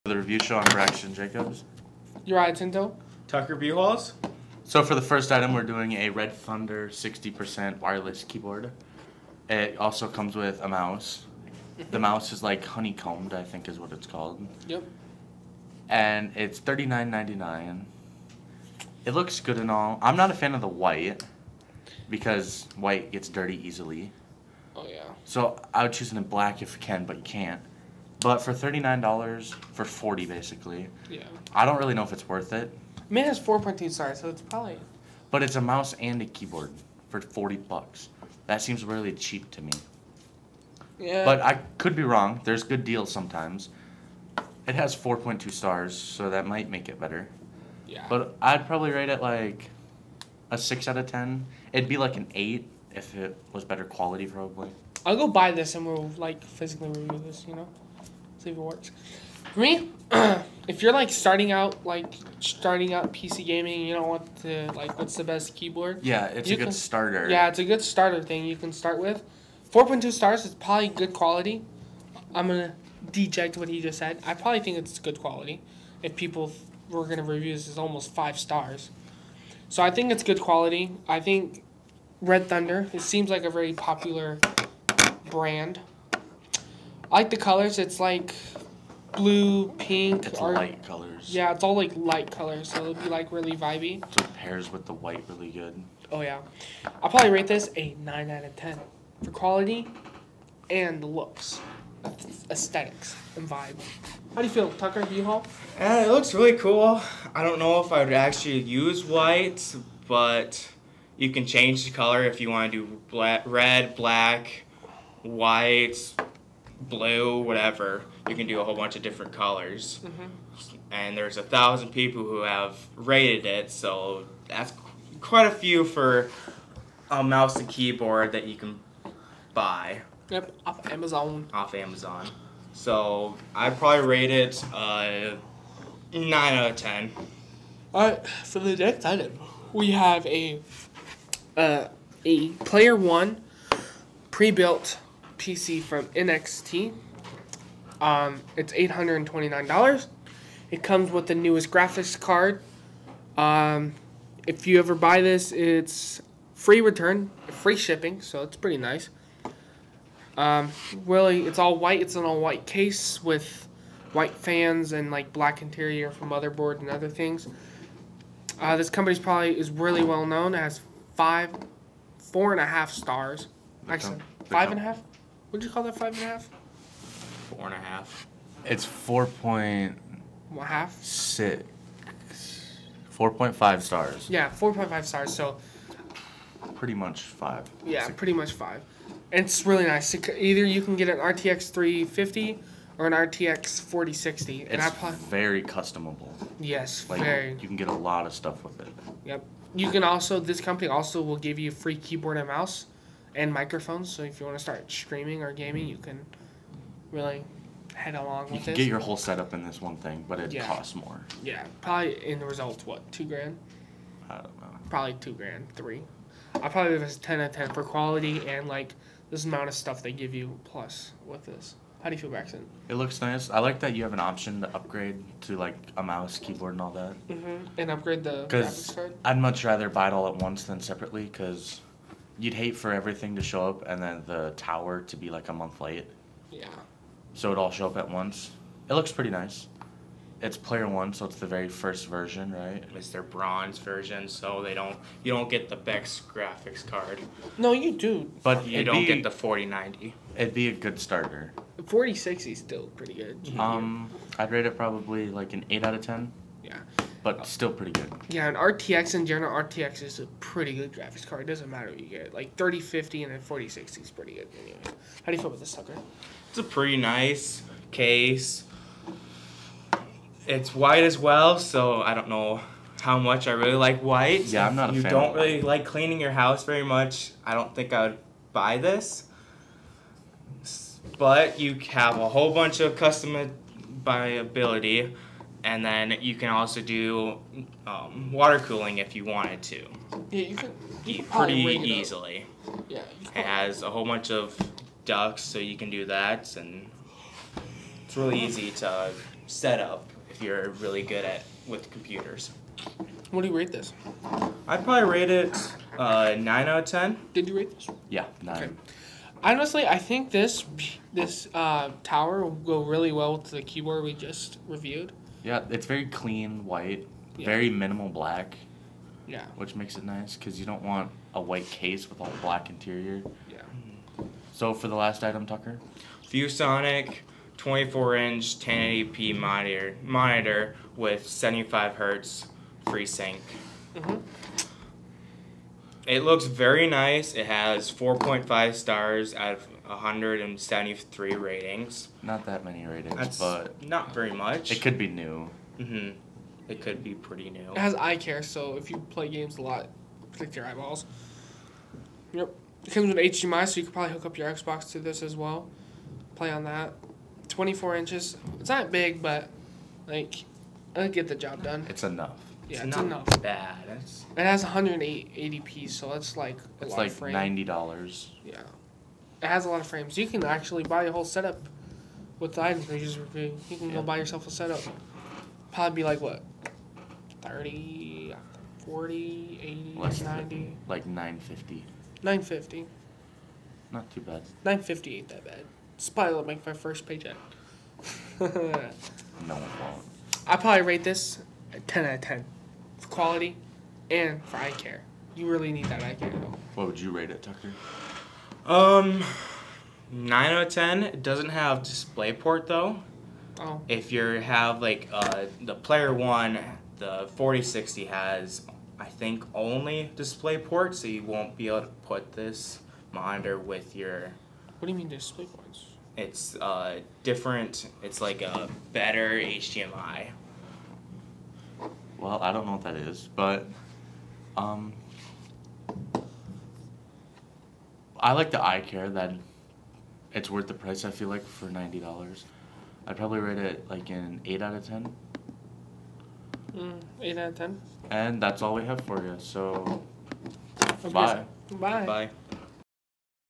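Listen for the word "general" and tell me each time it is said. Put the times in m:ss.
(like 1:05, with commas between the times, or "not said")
4:19.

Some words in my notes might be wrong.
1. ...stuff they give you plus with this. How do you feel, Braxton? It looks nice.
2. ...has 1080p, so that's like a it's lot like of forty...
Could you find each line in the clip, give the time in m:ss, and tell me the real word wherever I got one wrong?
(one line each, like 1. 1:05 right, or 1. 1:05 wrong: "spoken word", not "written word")
1. 3:39 right
2. 6:04 wrong: "ninety", not "forty".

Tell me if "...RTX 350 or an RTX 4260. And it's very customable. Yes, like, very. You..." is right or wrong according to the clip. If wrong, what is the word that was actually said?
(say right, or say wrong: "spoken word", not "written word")
wrong: "4060", not "4260".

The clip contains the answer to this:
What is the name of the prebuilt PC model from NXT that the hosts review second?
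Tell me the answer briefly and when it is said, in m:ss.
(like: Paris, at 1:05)
Player 1, at 2:22.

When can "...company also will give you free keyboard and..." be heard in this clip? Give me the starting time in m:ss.
3:20.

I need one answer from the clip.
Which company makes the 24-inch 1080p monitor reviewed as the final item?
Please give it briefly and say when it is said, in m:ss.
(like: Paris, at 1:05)
ViewSonic, at 5:26.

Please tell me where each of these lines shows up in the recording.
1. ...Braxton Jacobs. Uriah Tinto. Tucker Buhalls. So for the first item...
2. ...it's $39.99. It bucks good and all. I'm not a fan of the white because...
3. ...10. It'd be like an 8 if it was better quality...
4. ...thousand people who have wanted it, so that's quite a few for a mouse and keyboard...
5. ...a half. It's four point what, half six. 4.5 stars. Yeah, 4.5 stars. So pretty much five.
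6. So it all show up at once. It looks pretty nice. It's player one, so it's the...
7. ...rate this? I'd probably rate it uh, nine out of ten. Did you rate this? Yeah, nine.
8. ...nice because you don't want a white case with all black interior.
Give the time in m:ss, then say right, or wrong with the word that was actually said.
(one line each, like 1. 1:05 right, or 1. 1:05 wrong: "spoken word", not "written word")
1. 0:00 right
2. 0:16 wrong: "looks", not "bucks"
3. 0:51 right
4. 2:01 wrong: "rated", not "wanted"
5. 2:57 right
6. 3:57 right
7. 5:03 right
8. 5:20 right.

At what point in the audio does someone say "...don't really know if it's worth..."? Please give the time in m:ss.
0:31.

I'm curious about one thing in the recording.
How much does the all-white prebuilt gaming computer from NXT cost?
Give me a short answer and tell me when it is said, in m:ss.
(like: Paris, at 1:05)
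$829, at 2:28.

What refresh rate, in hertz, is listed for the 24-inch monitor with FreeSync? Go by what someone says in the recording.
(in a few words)
75 hertz.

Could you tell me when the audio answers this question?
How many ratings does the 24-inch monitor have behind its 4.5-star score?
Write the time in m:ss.
5:39.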